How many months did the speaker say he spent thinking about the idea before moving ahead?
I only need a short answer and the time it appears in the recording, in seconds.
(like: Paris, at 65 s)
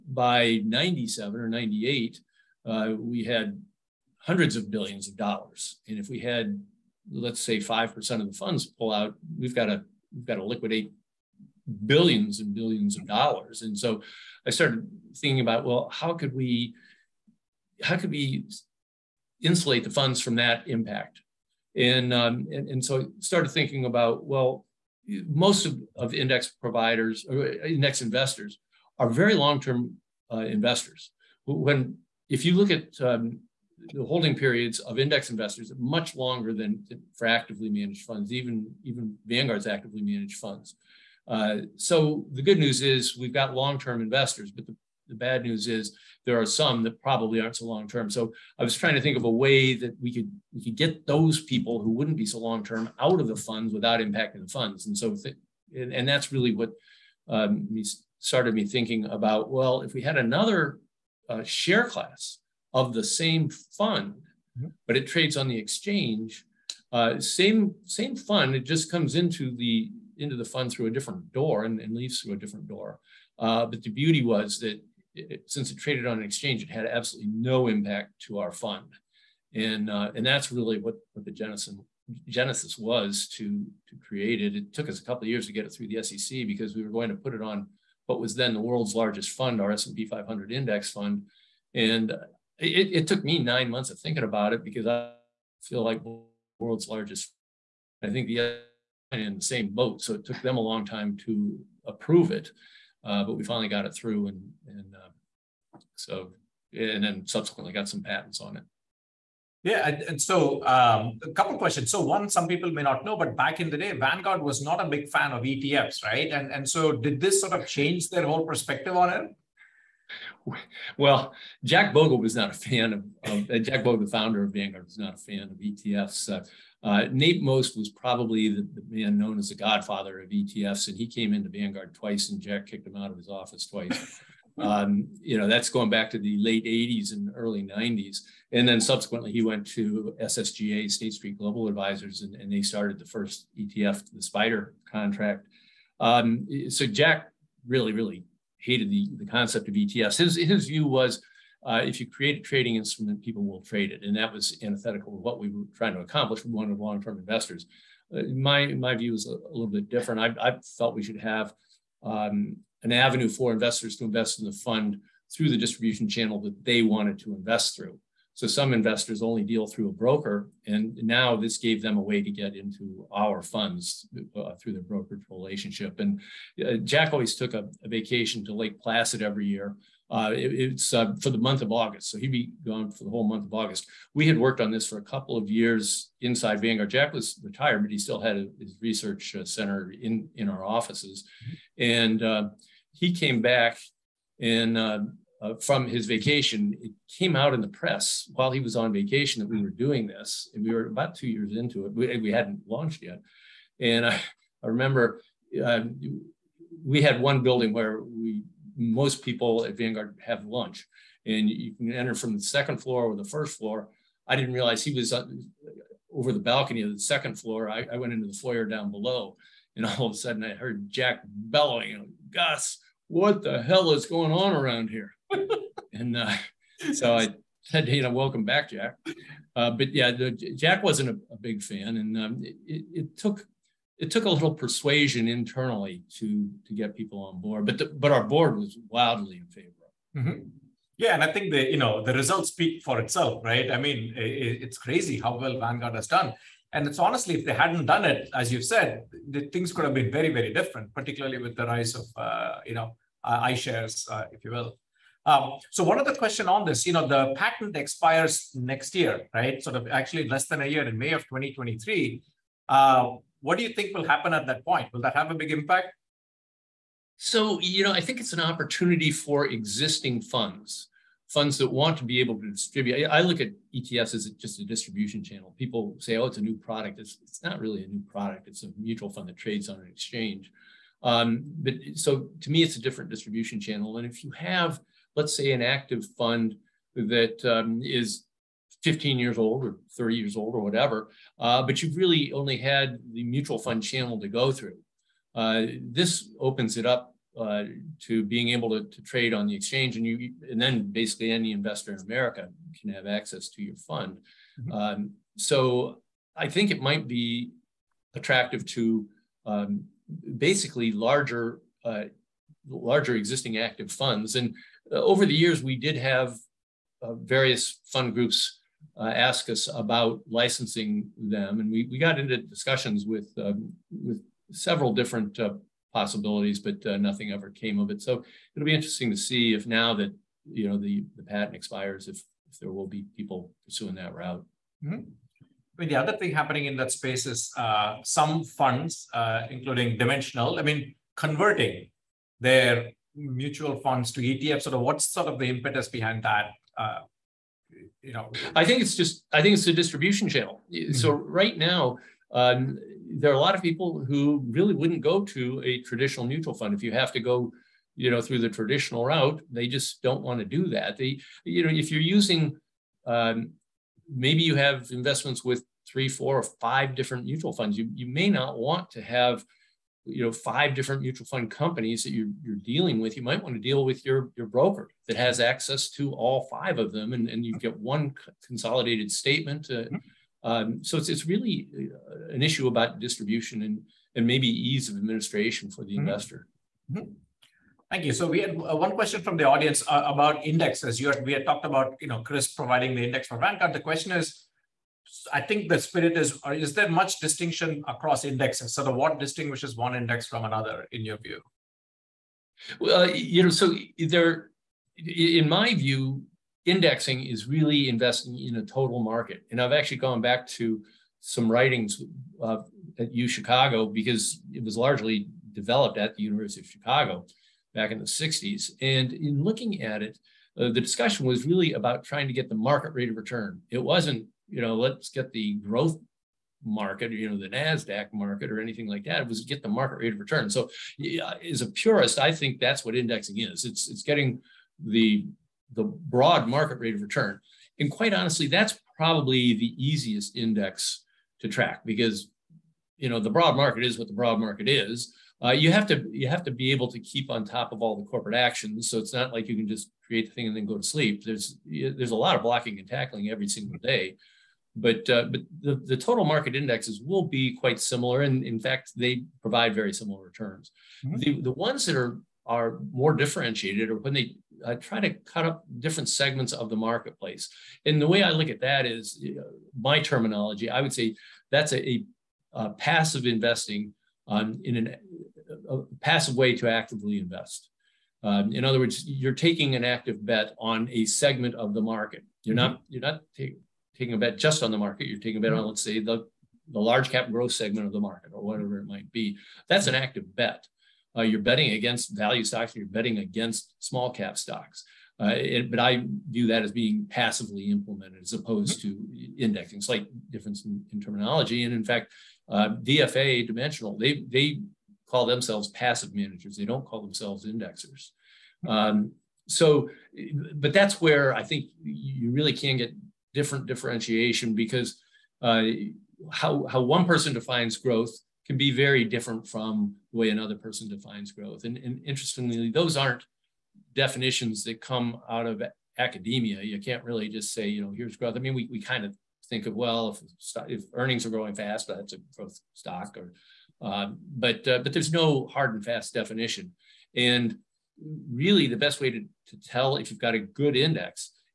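9, at 93 s.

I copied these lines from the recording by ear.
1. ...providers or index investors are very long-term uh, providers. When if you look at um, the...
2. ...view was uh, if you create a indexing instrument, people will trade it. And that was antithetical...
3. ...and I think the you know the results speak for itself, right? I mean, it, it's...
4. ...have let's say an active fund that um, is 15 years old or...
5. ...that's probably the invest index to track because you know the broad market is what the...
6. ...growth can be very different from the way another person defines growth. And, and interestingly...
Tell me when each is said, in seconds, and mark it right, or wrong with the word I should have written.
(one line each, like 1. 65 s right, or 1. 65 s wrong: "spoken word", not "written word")
1. 26 s wrong: "investors", not "providers"
2. 150 s wrong: "trading", not "indexing"
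3. 241 s right
4. 284 s right
5. 438 s wrong: "easiest", not "invest"
6. 517 s right.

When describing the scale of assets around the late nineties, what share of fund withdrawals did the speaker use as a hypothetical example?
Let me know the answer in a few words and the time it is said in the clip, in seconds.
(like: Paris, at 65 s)
5%, at 7 s.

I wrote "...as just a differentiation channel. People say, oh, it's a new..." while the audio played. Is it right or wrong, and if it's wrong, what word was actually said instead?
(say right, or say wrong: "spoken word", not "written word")
wrong: "distribution", not "differentiation".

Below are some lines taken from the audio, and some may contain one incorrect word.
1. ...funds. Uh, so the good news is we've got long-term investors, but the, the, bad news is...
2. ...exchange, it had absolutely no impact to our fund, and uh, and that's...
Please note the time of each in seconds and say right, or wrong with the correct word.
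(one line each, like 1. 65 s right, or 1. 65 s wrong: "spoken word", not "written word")
1. 40 s right
2. 76 s right.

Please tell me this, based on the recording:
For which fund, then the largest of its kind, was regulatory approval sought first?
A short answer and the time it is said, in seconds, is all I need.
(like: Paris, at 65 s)
S&P 500 index fund, at 89 s.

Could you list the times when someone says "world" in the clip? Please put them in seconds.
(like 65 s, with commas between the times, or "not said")
88 s, 96 s.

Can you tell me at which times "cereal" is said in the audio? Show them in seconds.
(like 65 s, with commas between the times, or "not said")
not said.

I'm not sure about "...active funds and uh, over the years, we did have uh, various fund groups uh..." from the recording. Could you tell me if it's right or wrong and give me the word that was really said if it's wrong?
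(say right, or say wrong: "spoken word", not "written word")
right.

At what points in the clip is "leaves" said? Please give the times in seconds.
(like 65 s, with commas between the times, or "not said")
71 s.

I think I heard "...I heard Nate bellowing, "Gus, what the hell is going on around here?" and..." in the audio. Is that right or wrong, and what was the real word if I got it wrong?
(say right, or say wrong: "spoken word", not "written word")
wrong: "Jack", not "Nate".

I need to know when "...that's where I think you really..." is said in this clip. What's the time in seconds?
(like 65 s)
510 s.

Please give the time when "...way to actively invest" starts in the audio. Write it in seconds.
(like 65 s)
476 s.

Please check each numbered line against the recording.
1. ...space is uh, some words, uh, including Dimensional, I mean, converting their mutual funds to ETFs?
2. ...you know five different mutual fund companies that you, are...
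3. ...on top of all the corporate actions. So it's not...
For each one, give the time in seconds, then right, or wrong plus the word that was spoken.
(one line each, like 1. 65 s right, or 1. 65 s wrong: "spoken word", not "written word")
1. 337 s wrong: "funds", not "words"
2. 370 s right
3. 447 s right.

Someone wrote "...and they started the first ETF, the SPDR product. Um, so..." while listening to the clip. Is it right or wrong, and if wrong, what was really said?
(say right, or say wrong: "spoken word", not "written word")
wrong: "contract", not "product".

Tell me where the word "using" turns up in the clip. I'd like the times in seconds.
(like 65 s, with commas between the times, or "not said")
362 s.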